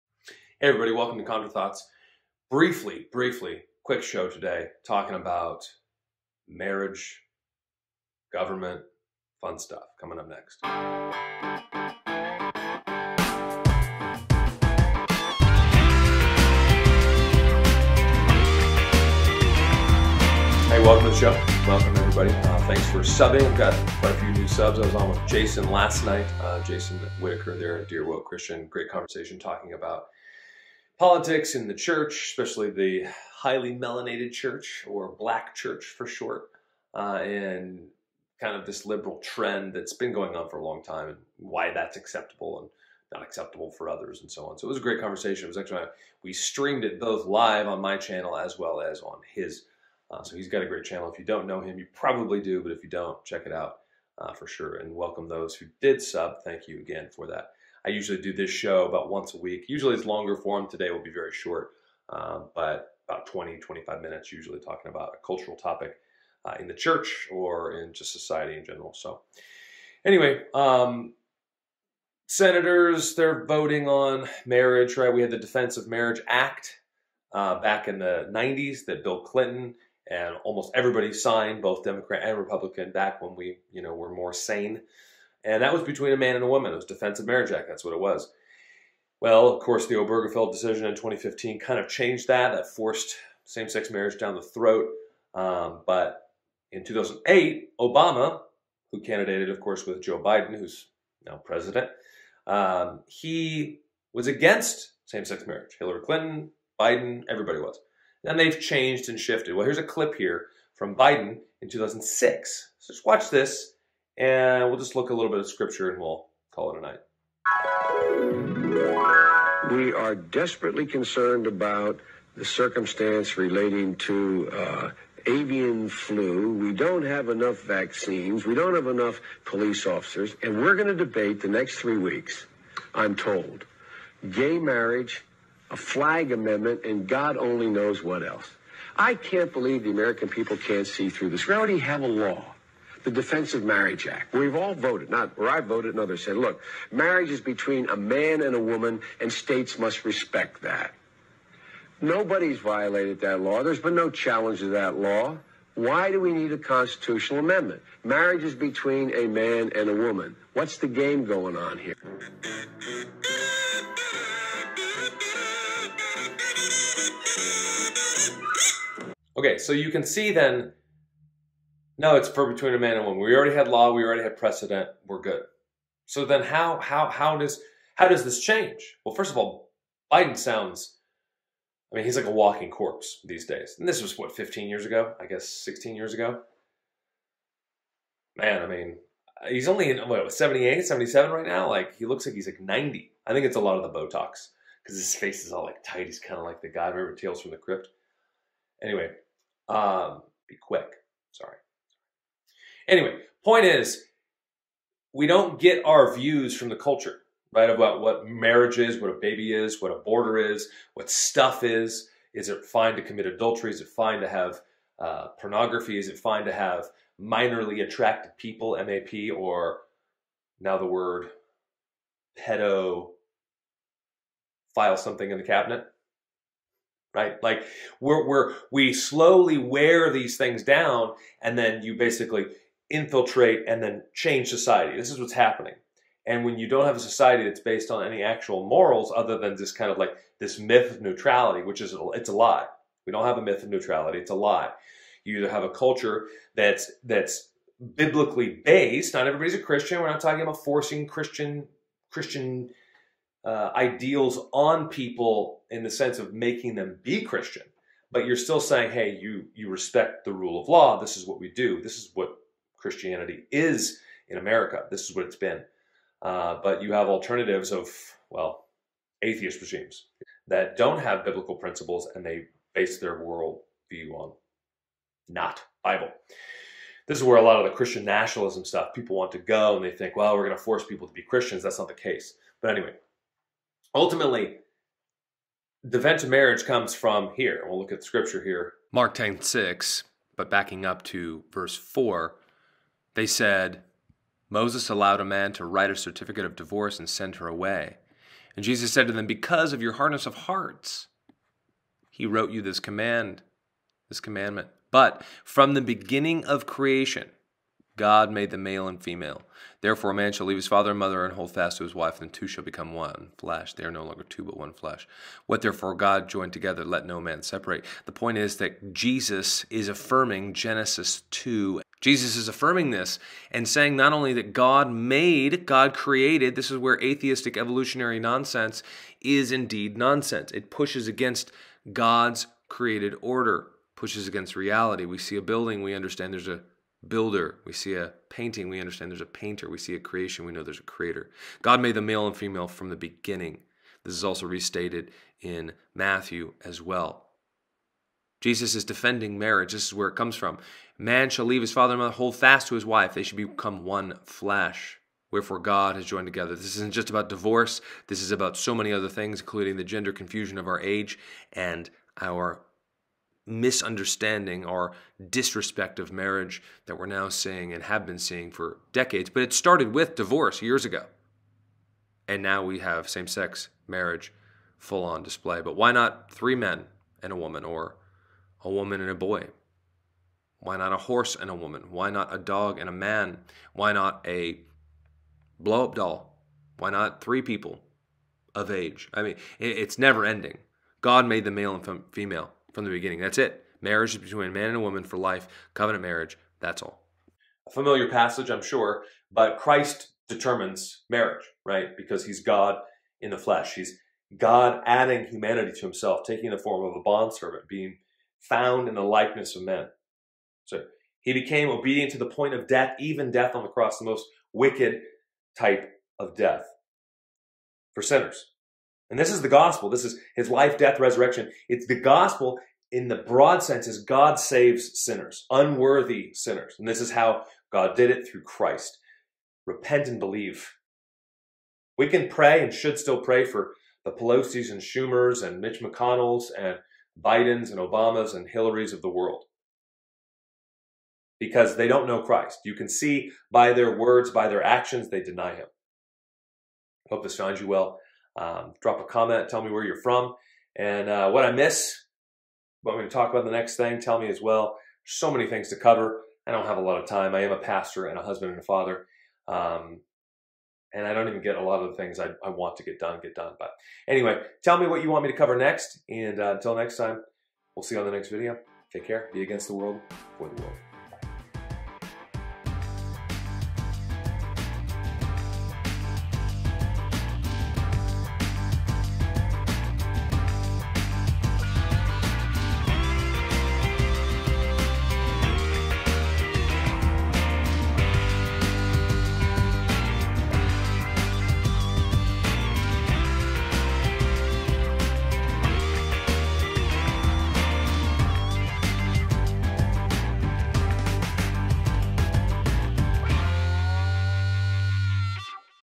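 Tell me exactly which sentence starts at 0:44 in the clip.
So it was a great conversation.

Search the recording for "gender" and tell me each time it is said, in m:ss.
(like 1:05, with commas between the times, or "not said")
5:59.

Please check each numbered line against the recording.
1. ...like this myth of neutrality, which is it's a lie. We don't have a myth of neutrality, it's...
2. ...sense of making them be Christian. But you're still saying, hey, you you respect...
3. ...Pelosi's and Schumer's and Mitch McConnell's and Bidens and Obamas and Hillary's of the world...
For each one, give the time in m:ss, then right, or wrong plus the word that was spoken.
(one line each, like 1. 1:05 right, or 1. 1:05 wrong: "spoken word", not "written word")
1. 3:59 right
2. 4:15 right
3. 7:14 right.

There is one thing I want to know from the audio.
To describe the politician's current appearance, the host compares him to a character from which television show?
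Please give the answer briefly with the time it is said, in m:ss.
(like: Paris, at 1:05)
Tales from the Crypt, at 3:17.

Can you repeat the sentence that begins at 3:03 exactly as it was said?
And this was what 15 years ago, I guess 16 years ago.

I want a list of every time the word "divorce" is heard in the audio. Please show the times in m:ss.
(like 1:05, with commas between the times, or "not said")
4:56, 5:57, 6:10.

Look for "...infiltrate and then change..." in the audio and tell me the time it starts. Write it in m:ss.
3:52.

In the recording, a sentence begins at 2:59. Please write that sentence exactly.
Well, first of all, Biden sounds.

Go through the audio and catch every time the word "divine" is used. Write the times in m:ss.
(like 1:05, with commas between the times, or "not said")
not said.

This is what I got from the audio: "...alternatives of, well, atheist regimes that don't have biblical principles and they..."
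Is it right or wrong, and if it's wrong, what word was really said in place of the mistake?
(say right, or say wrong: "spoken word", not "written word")
right.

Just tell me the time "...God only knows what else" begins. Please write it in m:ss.
2:17.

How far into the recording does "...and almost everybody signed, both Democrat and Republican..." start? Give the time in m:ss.
1:20.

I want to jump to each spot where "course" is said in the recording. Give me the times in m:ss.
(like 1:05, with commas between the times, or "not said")
1:29, 1:39.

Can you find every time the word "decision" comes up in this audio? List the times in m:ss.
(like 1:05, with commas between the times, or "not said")
1:30.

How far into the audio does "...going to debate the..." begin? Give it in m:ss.
2:10.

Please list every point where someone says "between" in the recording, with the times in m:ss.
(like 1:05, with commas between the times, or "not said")
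1:25, 2:27, 2:38, 2:52, 6:34.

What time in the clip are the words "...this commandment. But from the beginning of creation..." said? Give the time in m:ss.
5:04.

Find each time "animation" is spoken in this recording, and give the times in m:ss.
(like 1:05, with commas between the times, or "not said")
not said.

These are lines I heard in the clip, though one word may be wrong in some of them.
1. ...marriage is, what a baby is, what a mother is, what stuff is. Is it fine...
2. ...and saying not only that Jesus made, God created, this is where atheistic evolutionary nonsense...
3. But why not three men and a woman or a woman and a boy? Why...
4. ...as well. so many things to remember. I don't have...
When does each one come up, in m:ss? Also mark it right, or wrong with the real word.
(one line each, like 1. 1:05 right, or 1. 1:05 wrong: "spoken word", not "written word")
1. 3:28 wrong: "border", not "mother"
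2. 5:23 wrong: "God", not "Jesus"
3. 6:15 right
4. 7:34 wrong: "cover", not "remember".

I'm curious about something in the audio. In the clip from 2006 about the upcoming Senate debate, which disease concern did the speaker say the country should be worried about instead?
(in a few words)
avian flu.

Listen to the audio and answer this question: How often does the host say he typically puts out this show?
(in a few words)
once a week.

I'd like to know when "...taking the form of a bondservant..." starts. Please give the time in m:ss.
6:46.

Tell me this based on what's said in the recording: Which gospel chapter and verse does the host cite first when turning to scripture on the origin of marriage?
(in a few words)
Mark 10:6.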